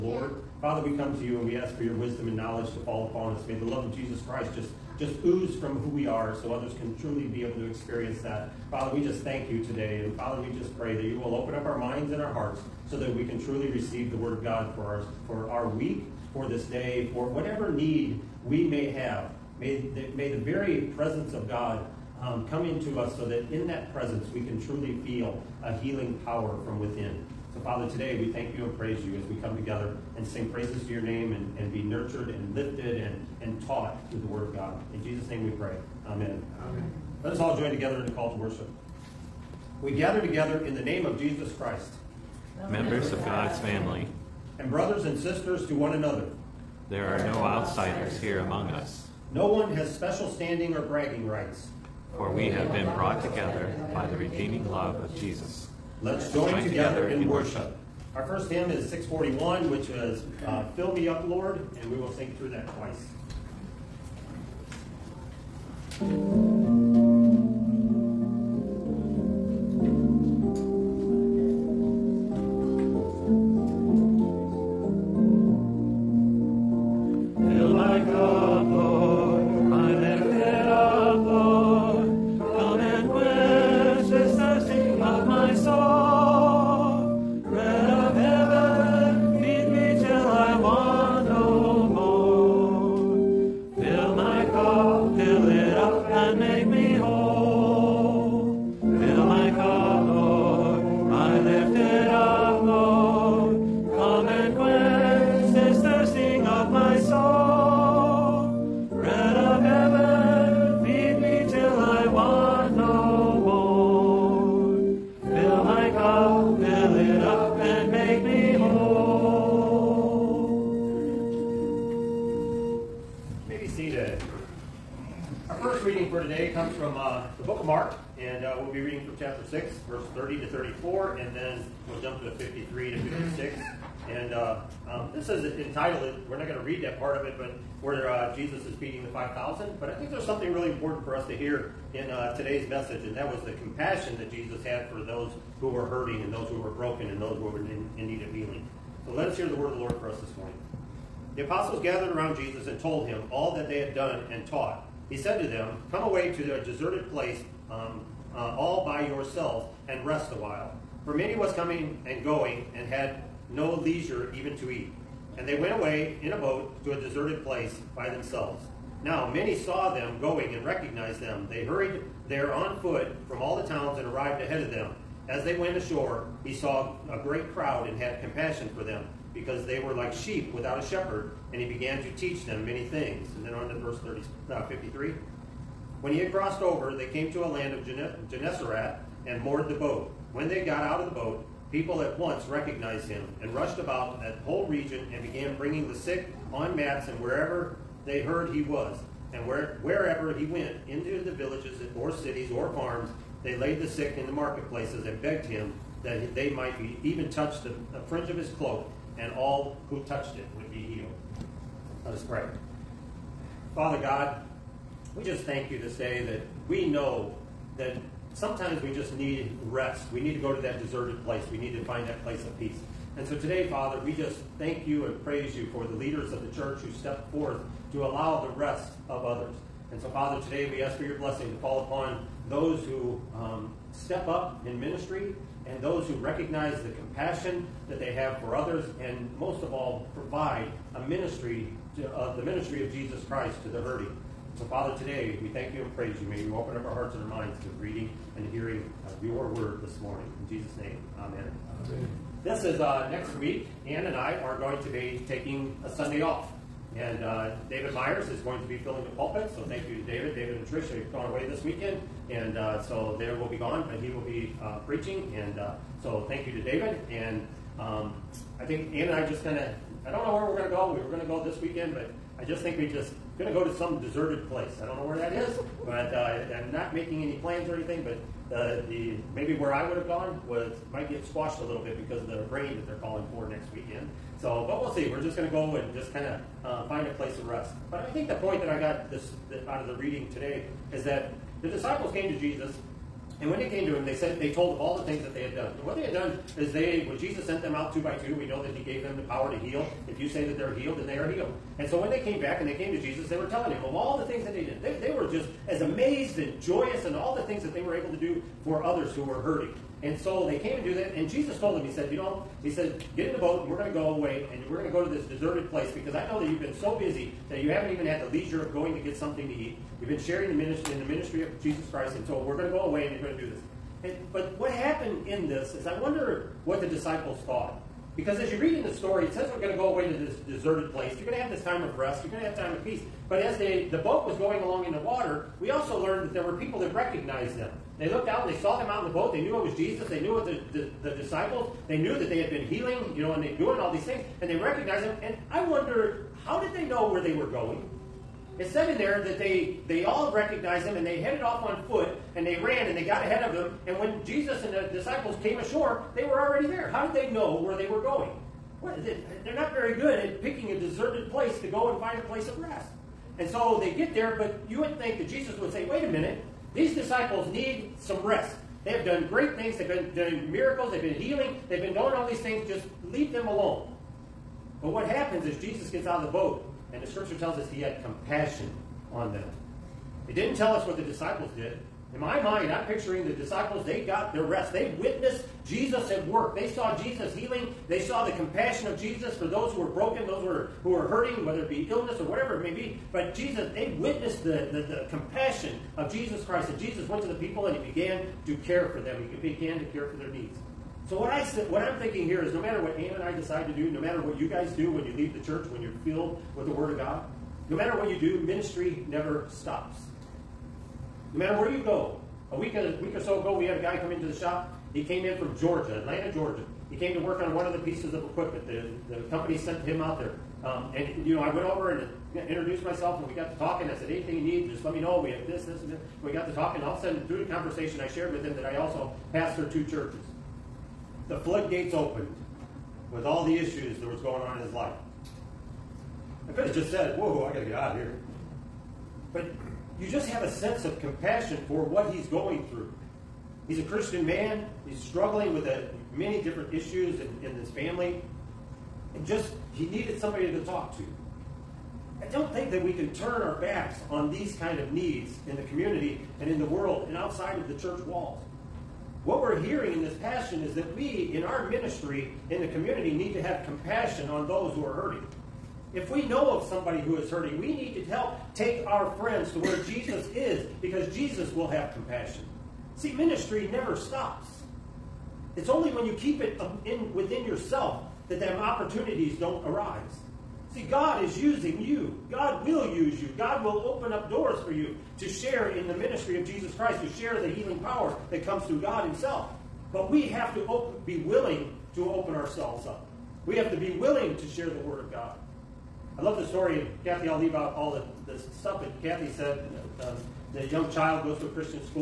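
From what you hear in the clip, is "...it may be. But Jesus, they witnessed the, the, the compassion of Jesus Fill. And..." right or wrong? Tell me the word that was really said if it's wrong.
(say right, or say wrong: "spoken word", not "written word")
wrong: "Christ", not "Fill".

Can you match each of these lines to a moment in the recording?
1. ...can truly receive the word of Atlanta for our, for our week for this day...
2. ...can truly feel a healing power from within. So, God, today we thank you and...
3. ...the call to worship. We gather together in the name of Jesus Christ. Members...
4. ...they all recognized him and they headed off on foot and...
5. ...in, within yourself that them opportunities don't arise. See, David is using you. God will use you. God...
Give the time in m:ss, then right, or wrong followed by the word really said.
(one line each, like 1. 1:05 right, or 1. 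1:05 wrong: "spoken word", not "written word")
1. 0:13 wrong: "God", not "Atlanta"
2. 0:24 wrong: "Father", not "God"
3. 0:38 right
4. 5:49 right
5. 7:56 wrong: "God", not "David".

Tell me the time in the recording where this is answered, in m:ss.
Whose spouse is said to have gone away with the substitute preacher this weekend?
4:20.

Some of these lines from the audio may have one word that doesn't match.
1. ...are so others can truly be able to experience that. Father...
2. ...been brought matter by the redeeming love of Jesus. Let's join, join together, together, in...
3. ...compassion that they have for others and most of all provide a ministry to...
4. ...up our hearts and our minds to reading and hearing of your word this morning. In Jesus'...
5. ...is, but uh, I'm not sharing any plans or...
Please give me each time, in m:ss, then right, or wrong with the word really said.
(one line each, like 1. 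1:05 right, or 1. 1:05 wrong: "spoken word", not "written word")
1. 0:06 right
2. 0:52 wrong: "together", not "matter"
3. 3:56 right
4. 4:06 right
5. 4:35 wrong: "making", not "sharing".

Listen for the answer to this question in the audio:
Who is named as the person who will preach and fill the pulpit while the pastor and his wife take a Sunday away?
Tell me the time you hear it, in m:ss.
4:17.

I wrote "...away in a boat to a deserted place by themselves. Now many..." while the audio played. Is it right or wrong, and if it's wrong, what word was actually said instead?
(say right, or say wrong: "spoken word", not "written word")
right.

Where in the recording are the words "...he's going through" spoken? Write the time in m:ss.
7:22.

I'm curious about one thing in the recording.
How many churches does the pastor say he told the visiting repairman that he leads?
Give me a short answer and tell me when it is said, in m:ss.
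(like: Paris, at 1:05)
2, at 7:09.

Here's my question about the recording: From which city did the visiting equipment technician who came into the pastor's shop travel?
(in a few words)
Atlanta, Georgia.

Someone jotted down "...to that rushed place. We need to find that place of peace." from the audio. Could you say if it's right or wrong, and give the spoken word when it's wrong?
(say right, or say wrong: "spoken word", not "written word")
wrong: "deserted", not "rushed".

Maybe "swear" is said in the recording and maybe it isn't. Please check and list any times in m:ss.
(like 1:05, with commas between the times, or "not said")
not said.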